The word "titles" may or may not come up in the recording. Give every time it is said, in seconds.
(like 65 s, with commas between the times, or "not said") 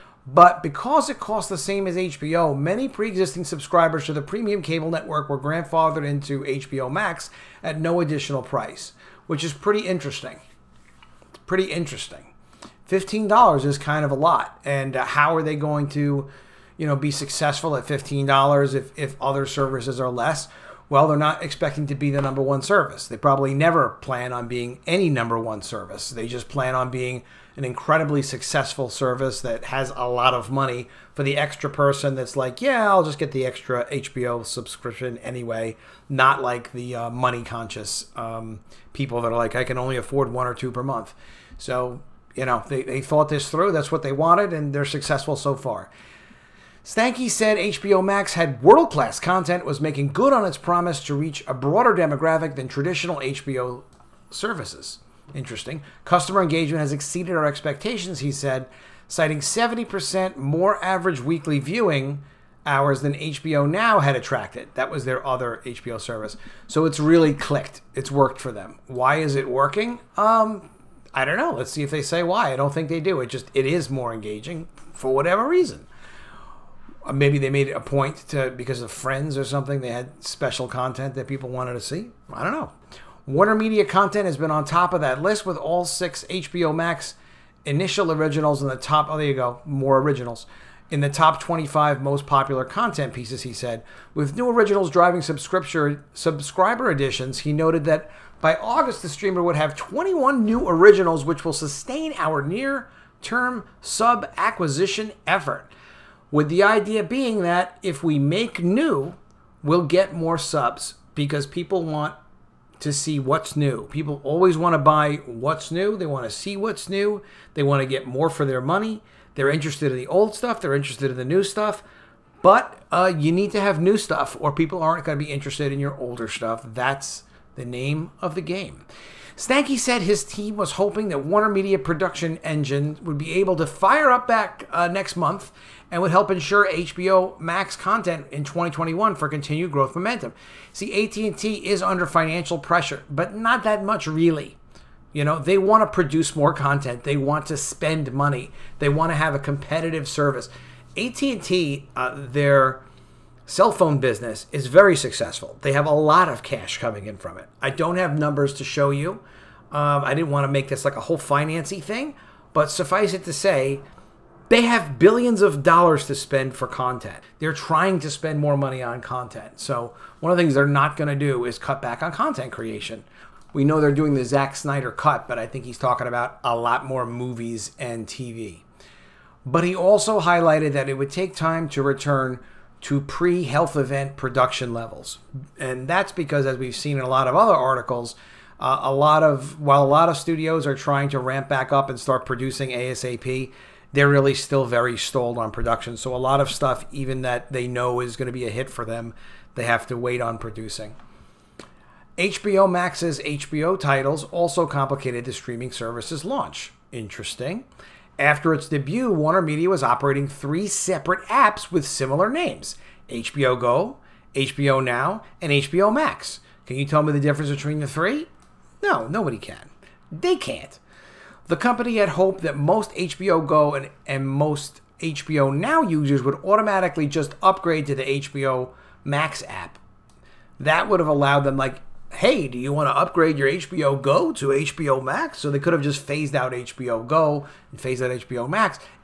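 203 s.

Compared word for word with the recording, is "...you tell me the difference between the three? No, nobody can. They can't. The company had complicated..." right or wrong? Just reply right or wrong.
wrong.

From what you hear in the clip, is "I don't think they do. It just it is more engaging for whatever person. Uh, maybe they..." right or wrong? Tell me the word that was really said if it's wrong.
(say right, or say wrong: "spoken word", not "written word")
wrong: "reason", not "person".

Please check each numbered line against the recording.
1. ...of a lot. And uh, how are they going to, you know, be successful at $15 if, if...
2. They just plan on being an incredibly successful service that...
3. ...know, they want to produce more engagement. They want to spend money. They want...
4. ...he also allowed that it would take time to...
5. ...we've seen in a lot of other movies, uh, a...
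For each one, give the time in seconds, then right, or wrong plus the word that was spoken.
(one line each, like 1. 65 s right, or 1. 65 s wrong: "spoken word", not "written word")
1. 14 s right
2. 26 s right
3. 145 s wrong: "content", not "engagement"
4. 179 s wrong: "highlighted", not "allowed"
5. 186 s wrong: "articles", not "movies".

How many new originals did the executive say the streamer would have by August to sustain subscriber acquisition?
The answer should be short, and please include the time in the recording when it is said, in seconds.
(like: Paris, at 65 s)
21, at 99 s.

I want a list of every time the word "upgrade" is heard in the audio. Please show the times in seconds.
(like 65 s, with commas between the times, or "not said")
227 s, 232 s.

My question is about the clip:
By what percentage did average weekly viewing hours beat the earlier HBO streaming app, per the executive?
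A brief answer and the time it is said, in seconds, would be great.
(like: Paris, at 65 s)
70%, at 59 s.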